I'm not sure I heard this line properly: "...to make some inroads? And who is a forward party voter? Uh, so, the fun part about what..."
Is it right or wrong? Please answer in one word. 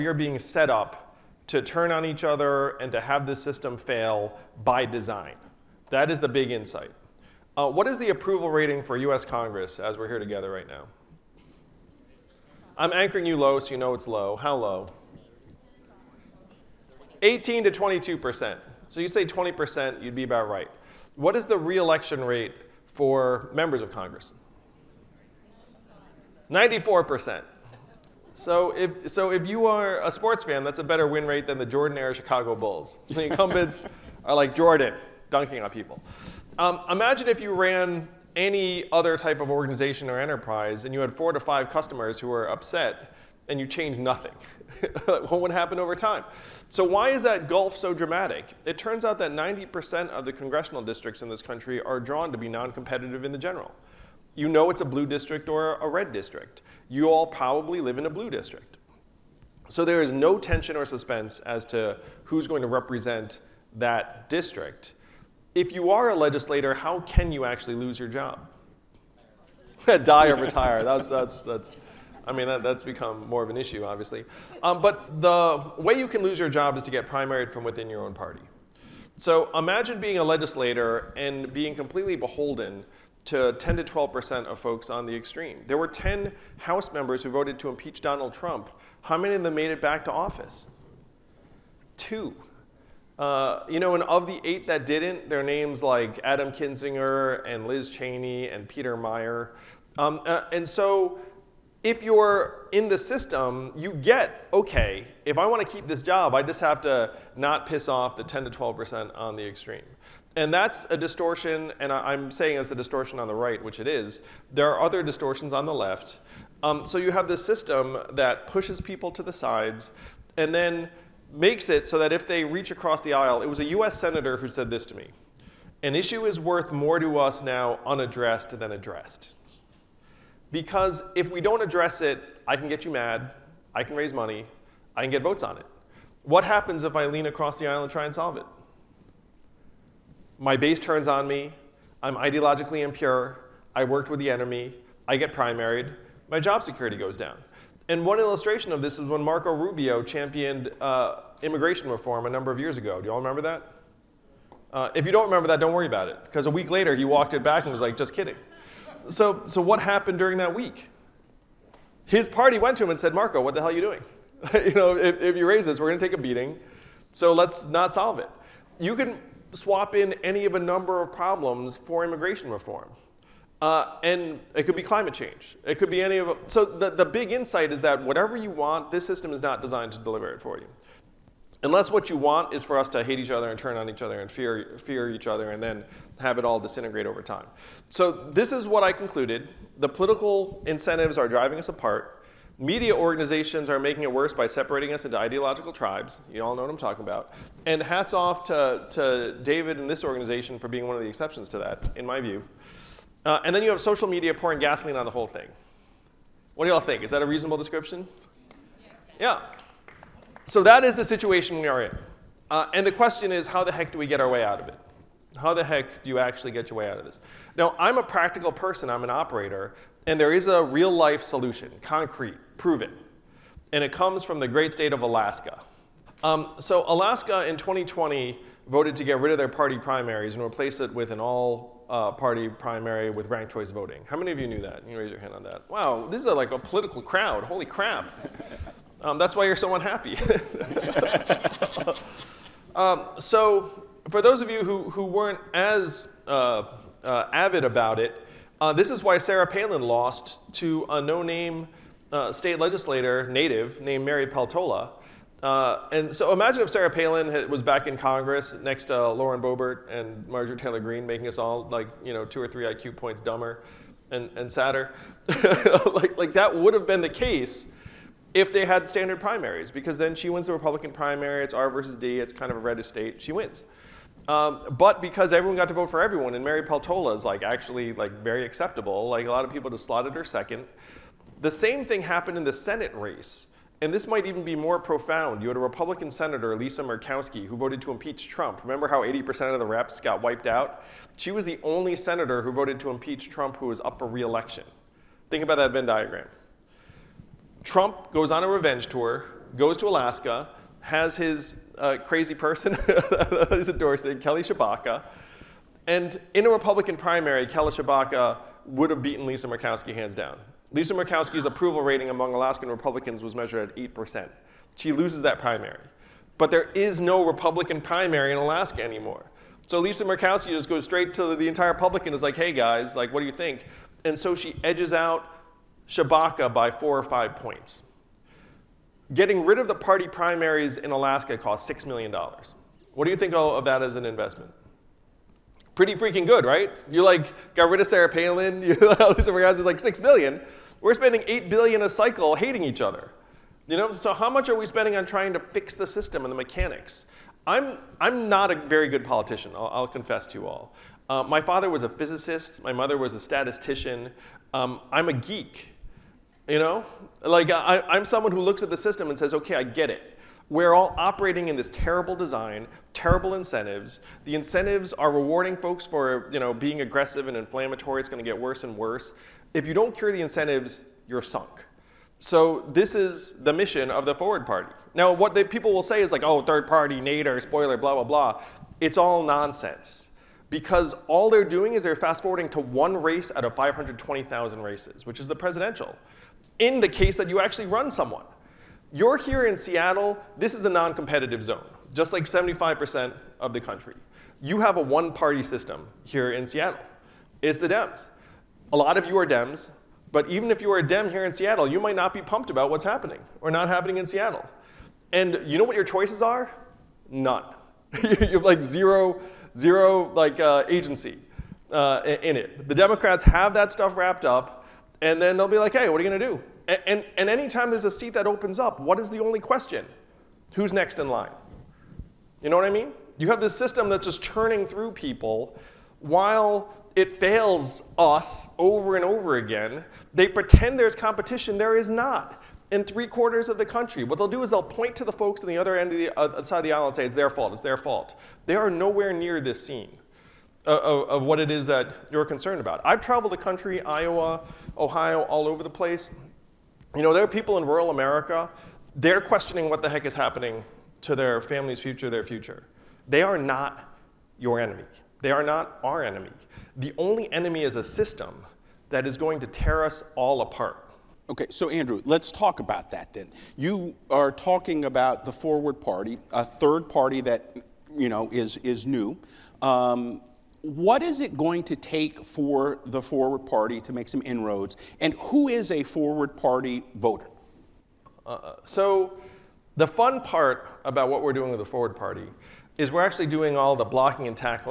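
right.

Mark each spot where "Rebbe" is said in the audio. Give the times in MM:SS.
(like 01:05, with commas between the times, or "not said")
not said.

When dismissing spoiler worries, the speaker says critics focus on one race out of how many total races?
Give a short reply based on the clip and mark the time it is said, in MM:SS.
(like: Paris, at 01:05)
520,000, at 06:23.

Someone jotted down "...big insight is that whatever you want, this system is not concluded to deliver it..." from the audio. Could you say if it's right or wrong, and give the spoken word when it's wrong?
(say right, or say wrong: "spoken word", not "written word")
wrong: "designed", not "concluded".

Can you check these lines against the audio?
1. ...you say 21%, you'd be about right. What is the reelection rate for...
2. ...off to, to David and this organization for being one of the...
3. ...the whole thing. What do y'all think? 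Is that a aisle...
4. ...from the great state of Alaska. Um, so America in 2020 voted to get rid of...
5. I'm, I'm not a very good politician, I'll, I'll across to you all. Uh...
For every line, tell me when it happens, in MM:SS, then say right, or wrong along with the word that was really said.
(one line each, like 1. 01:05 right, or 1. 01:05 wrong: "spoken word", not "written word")
1. 00:19 wrong: "20", not "21"
2. 03:18 right
3. 03:25 wrong: "reasonable", not "aisle"
4. 03:44 wrong: "Alaska", not "America"
5. 05:47 wrong: "confess", not "across".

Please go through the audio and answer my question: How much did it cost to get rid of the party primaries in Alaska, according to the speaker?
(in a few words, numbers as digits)
$6 million.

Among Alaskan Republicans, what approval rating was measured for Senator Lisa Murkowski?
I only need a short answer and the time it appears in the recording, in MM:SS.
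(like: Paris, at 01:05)
8%, at 05:13.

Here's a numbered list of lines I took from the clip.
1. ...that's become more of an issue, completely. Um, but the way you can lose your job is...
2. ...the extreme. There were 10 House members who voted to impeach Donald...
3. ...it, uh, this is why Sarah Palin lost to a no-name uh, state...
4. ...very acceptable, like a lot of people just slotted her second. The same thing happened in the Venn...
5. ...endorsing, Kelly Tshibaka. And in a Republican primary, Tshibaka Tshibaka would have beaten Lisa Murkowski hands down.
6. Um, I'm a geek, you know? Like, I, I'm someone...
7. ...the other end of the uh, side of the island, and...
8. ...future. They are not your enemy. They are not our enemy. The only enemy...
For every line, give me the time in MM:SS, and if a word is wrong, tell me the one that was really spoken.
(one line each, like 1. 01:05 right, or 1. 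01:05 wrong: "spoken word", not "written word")
1. 01:12 wrong: "obviously", not "completely"
2. 01:25 right
3. 04:07 right
4. 04:38 wrong: "Senate", not "Venn"
5. 05:03 wrong: "Kelly", not "Tshibaka"
6. 05:54 right
7. 07:15 right
8. 07:32 right.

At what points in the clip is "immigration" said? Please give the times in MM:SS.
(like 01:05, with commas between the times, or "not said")
02:31, 02:52.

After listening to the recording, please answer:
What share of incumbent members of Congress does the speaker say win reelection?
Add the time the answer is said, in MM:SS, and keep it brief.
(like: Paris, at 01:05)
94%, at 00:26.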